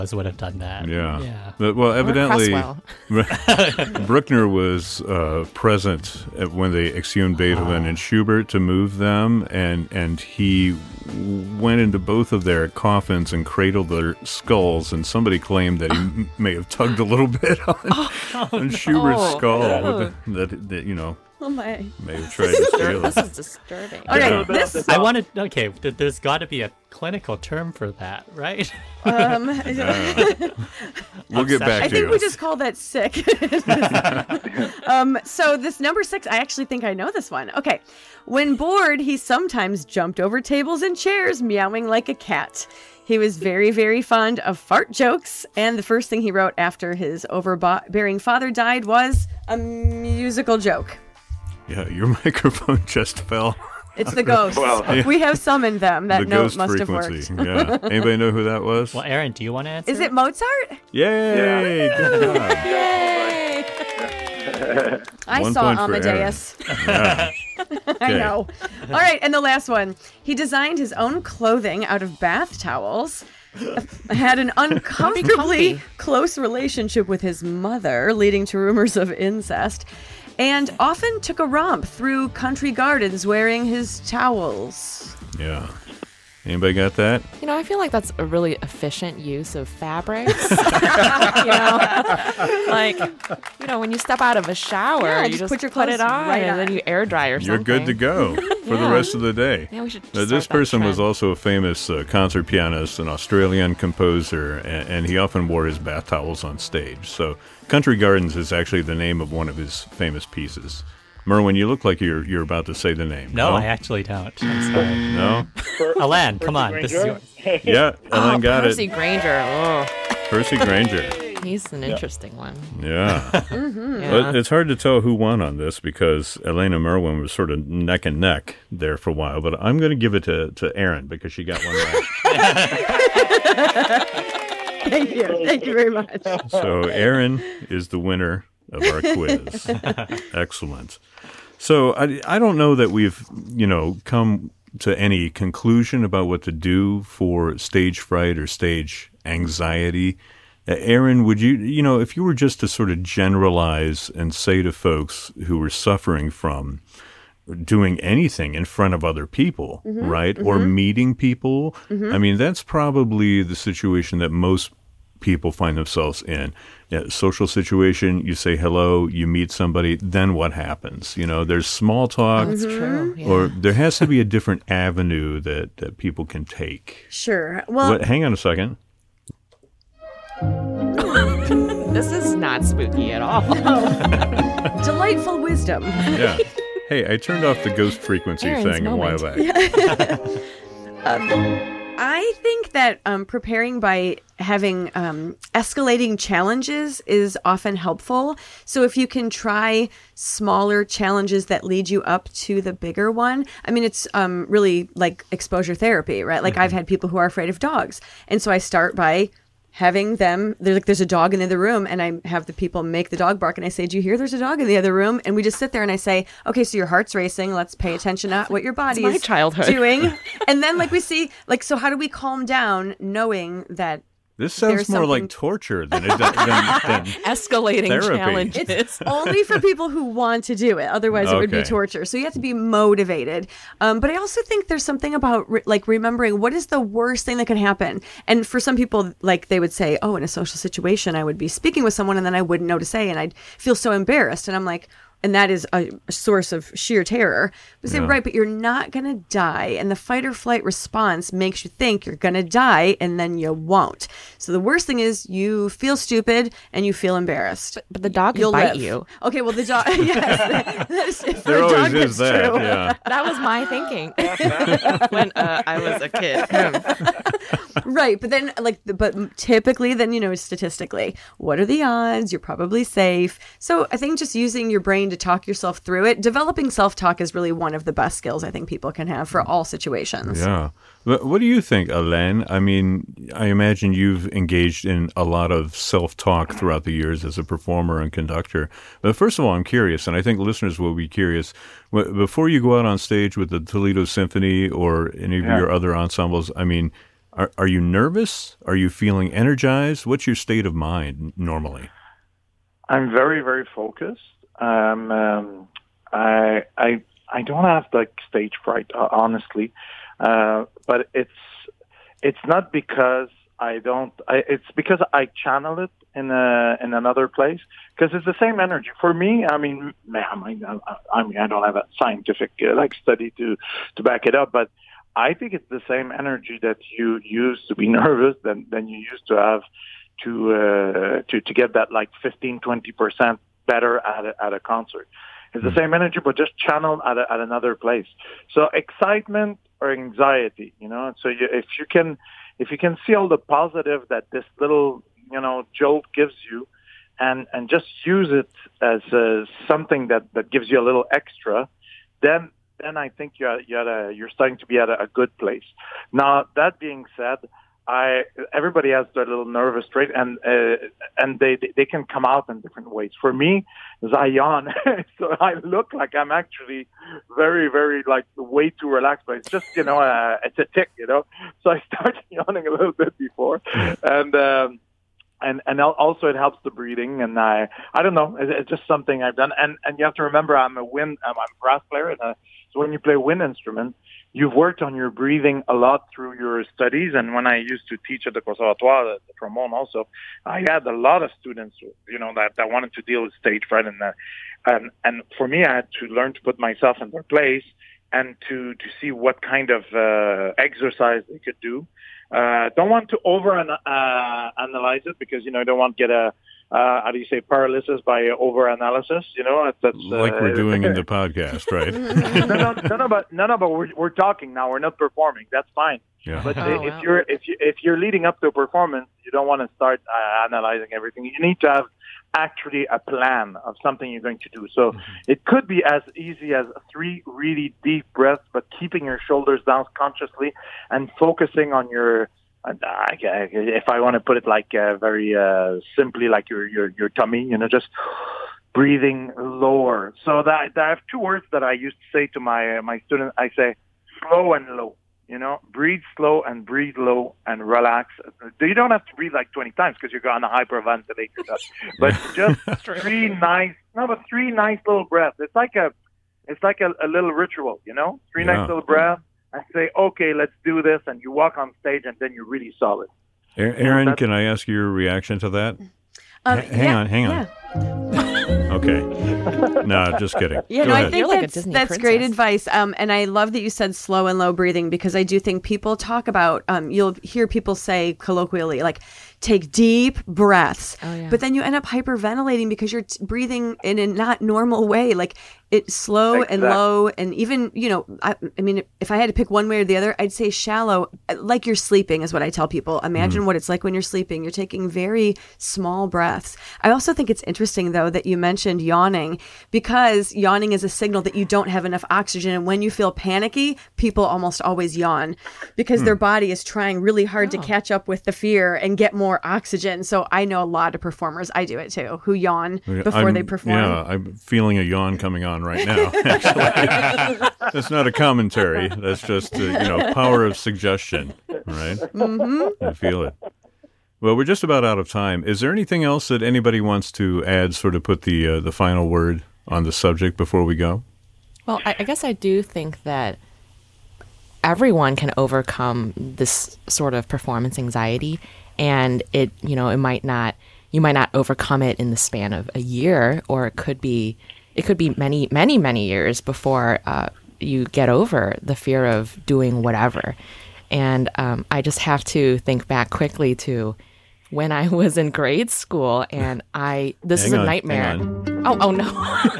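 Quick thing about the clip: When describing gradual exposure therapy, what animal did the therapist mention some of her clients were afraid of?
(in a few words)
dogs.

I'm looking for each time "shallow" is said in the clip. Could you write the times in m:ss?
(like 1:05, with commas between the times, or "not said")
8:10.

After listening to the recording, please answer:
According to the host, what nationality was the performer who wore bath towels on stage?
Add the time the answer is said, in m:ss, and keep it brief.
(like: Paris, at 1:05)
Australian, at 1:43.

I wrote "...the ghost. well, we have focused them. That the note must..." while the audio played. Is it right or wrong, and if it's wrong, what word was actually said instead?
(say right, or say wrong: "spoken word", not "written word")
wrong: "summoned", not "focused".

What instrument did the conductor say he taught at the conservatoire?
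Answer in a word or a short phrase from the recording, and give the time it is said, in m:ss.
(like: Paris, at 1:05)
trombone, at 6:29.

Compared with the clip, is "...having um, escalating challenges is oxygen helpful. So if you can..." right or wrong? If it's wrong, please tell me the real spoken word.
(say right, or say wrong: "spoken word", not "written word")
wrong: "often", not "oxygen".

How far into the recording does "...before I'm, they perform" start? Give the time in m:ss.
8:32.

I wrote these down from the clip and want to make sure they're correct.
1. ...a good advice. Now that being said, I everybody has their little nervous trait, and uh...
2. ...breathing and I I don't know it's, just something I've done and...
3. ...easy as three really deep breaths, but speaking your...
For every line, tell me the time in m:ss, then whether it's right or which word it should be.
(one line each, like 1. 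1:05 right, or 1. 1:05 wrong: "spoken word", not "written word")
1. 5:55 wrong: "place", not "advice"
2. 6:16 right
3. 7:06 wrong: "keeping", not "speaking".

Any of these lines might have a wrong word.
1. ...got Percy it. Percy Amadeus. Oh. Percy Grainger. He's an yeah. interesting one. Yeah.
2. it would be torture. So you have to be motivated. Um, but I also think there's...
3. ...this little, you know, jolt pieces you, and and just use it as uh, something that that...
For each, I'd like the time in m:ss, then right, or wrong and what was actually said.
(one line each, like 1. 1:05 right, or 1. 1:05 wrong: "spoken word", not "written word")
1. 1:58 wrong: "Grainger", not "Amadeus"
2. 3:51 right
3. 5:44 wrong: "gives", not "pieces".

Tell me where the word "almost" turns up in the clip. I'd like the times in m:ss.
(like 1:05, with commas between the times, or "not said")
8:24.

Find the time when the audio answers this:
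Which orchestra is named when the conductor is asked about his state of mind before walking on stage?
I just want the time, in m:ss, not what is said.
4:53.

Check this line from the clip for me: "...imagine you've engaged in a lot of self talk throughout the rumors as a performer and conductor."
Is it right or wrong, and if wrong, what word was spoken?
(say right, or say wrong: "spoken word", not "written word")
wrong: "years", not "rumors".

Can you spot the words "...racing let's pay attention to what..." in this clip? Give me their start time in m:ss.
3:37.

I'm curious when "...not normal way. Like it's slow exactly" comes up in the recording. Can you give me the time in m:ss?
8:04.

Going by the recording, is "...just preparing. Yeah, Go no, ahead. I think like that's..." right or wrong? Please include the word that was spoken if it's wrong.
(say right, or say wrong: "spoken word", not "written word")
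wrong: "kidding", not "preparing".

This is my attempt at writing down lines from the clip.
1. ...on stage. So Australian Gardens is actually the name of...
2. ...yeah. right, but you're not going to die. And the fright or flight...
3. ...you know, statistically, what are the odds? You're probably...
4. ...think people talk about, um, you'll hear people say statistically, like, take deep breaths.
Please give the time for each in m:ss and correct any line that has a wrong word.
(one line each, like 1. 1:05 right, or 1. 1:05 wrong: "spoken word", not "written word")
1. 1:46 wrong: "Country", not "Australian"
2. 4:07 wrong: "fight", not "fright"
3. 4:30 right
4. 7:55 wrong: "colloquially", not "statistically".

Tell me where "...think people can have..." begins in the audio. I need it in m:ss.
4:38.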